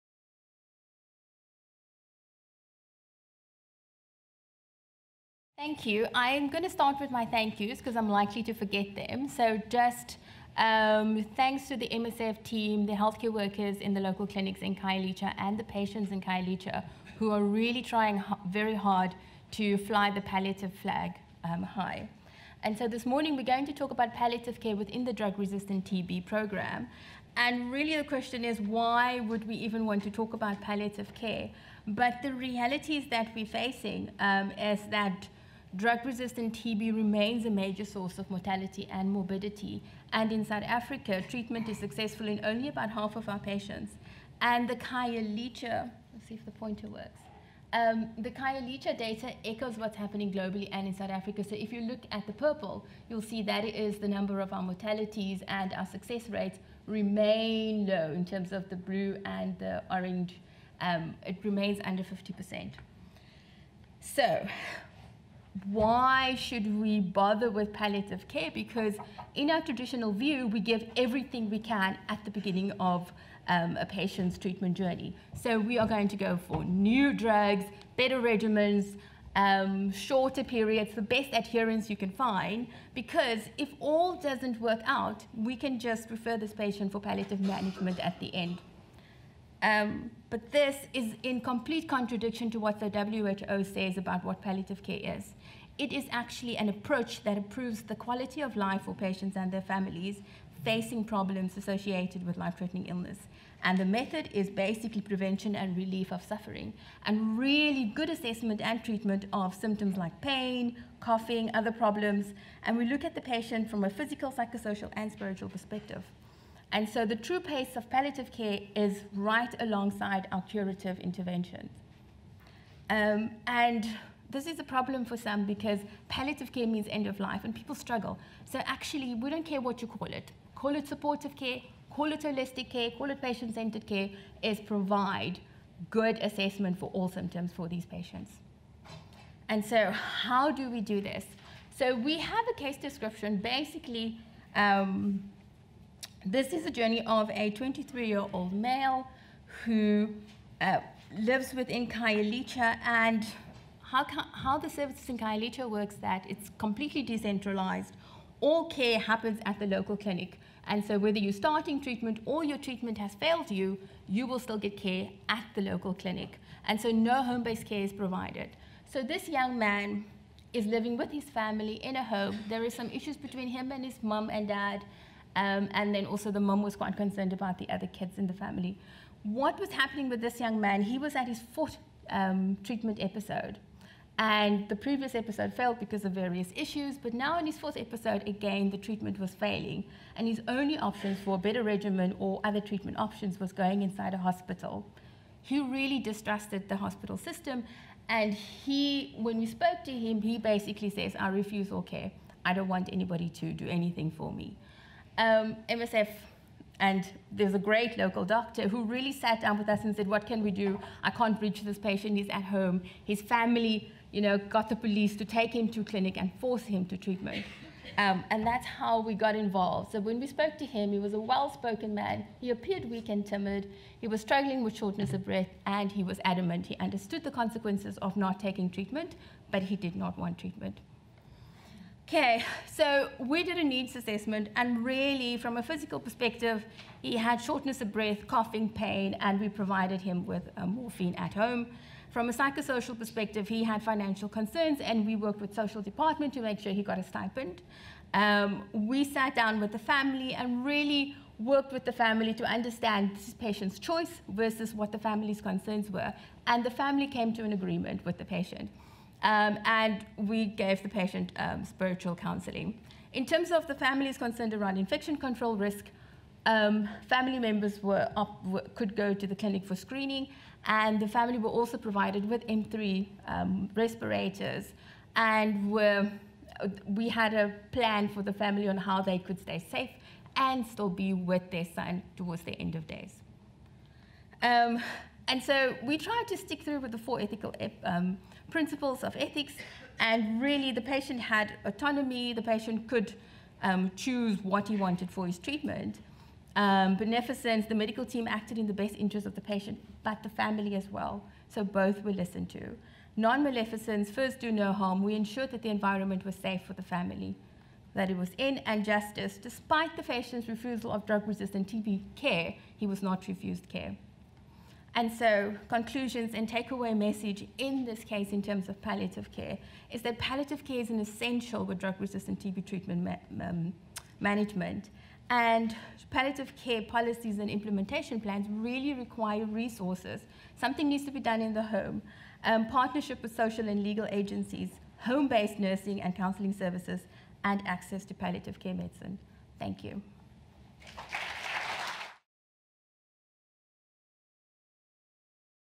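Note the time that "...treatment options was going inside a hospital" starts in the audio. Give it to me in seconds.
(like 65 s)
192 s.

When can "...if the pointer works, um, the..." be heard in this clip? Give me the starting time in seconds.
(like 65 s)
46 s.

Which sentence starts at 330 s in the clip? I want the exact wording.
Something needs to be done in the home.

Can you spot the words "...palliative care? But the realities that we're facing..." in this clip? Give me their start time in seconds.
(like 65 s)
30 s.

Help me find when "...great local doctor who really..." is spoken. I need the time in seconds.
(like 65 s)
207 s.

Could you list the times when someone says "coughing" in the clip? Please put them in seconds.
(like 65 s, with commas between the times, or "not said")
110 s, 238 s.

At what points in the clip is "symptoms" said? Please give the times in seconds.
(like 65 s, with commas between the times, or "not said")
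109 s, 137 s.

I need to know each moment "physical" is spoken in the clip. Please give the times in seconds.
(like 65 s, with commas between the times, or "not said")
113 s, 235 s.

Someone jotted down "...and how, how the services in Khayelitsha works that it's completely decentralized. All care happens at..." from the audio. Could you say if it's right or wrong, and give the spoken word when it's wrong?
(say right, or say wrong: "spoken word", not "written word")
right.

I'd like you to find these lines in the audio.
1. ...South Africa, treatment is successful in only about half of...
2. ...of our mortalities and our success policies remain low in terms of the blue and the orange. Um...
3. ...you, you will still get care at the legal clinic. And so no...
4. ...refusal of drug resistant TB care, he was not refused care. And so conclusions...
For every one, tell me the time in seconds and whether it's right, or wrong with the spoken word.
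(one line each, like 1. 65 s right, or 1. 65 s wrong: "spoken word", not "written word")
1. 40 s right
2. 54 s wrong: "rates", not "policies"
3. 163 s wrong: "local", not "legal"
4. 310 s right.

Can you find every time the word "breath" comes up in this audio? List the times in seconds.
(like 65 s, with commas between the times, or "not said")
225 s, 237 s.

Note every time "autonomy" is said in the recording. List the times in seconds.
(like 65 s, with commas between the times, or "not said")
291 s.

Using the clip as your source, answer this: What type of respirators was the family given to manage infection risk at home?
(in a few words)
M3.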